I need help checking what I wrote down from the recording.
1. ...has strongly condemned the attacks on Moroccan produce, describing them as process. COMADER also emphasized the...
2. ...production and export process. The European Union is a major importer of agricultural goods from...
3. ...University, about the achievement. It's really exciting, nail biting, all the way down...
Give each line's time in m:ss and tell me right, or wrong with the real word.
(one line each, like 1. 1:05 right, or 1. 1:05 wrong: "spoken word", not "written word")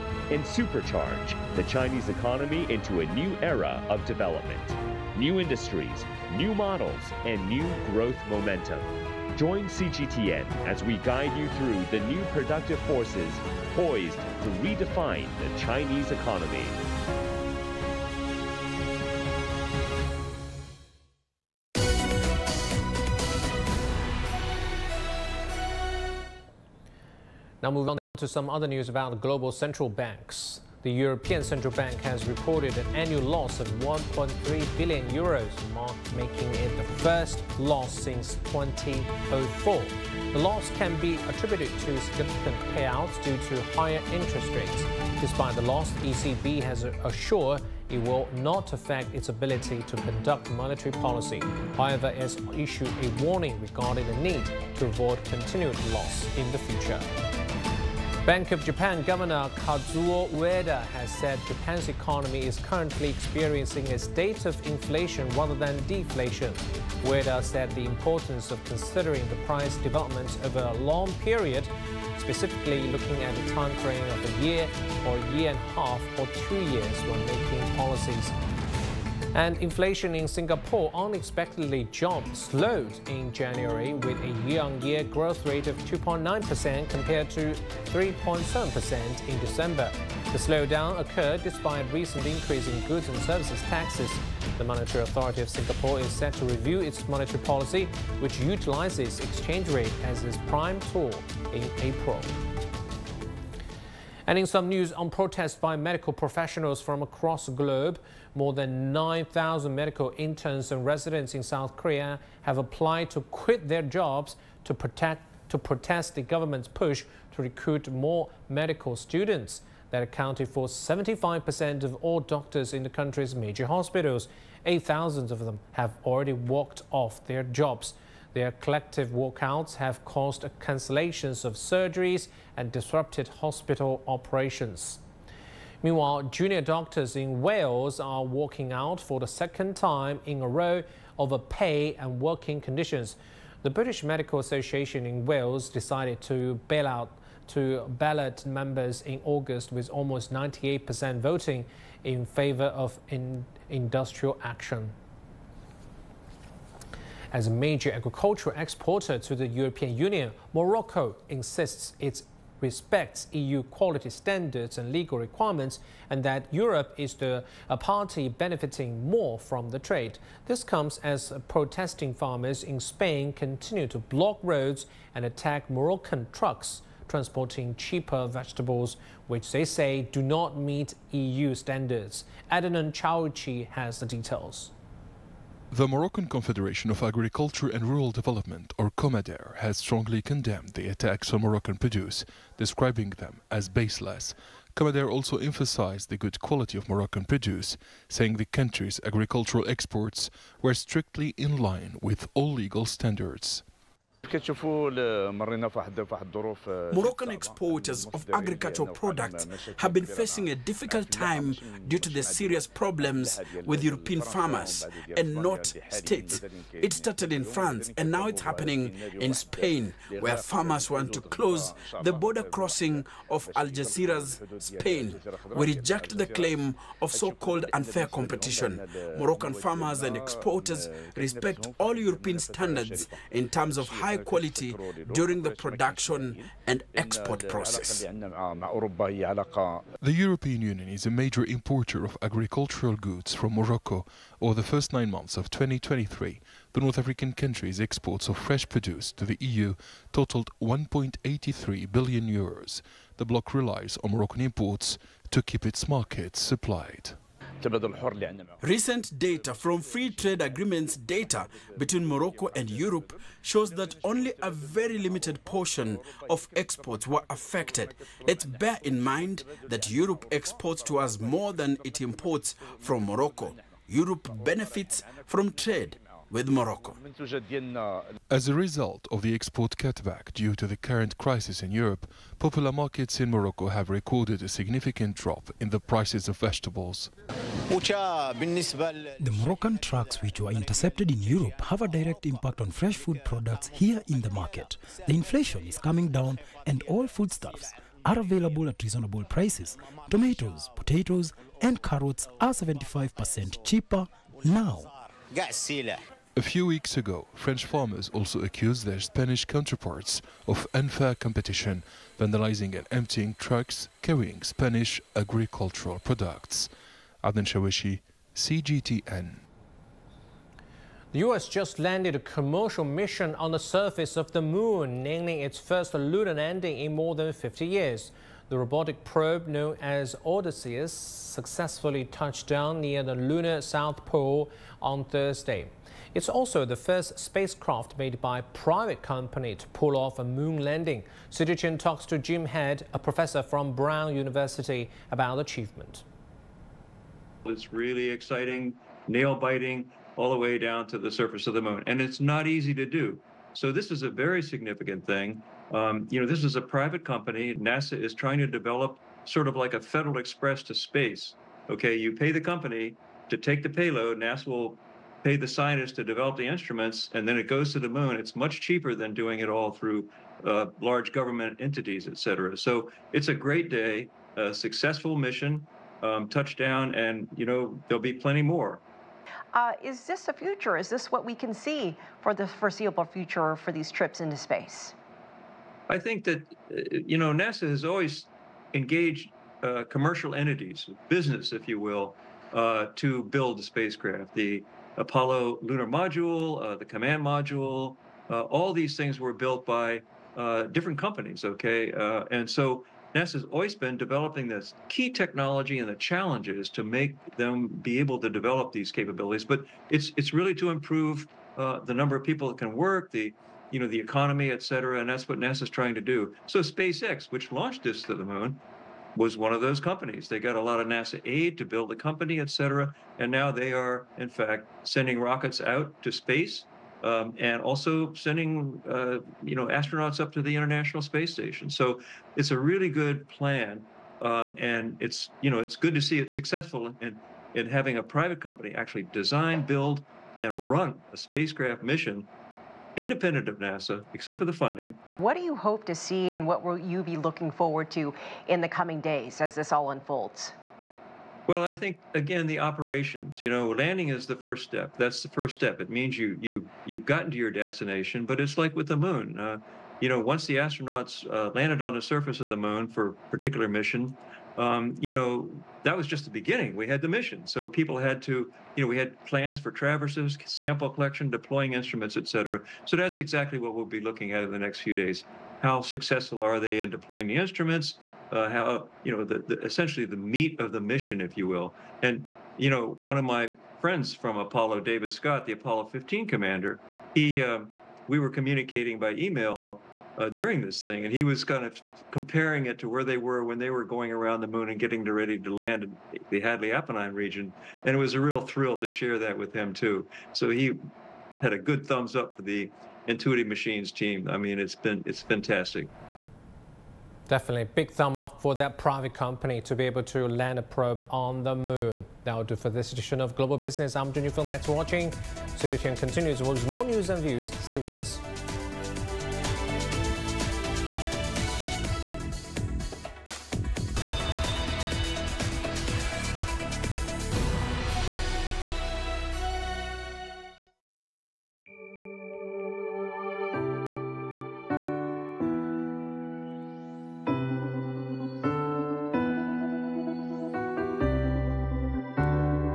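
1. 3:09 wrong: "baseless", not "process"
2. 3:55 right
3. 5:44 right.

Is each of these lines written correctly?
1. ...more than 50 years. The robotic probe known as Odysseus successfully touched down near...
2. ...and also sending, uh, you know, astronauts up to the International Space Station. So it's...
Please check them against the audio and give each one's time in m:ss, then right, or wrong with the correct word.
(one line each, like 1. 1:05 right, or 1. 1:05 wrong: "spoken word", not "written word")
1. 5:26 right
2. 7:07 right.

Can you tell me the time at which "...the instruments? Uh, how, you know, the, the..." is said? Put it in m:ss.
7:57.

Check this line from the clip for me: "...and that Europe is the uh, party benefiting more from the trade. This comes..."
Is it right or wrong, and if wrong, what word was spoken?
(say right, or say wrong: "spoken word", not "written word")
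right.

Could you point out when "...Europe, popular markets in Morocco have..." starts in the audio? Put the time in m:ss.
4:41.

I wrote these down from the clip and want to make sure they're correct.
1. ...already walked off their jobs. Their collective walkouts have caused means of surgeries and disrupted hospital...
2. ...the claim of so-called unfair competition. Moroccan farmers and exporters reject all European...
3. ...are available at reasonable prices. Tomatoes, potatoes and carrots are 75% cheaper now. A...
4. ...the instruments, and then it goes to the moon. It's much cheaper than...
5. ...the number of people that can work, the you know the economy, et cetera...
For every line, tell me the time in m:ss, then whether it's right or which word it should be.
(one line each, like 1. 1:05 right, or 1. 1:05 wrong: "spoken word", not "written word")
1. 2:06 wrong: "cancellations", not "means"
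2. 3:46 wrong: "respect", not "reject"
3. 4:58 right
4. 6:06 right
5. 6:51 right.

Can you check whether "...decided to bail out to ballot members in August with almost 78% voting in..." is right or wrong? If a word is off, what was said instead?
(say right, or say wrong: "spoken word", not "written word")
wrong: "98", not "78".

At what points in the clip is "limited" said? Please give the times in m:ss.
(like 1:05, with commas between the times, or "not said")
4:24.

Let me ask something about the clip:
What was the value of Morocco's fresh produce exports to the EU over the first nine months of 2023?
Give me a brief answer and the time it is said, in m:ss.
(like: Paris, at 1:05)
1.83 billion euros, at 4:10.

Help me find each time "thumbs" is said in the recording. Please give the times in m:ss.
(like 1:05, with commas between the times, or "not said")
8:21, 8:27.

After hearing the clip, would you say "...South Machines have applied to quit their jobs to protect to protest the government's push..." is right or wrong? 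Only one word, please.
wrong.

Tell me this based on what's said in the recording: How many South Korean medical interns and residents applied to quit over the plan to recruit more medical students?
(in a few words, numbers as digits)
More than 9,000.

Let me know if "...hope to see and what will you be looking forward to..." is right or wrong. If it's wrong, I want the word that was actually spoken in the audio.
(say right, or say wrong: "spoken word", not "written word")
right.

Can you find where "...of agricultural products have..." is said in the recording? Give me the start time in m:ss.
3:28.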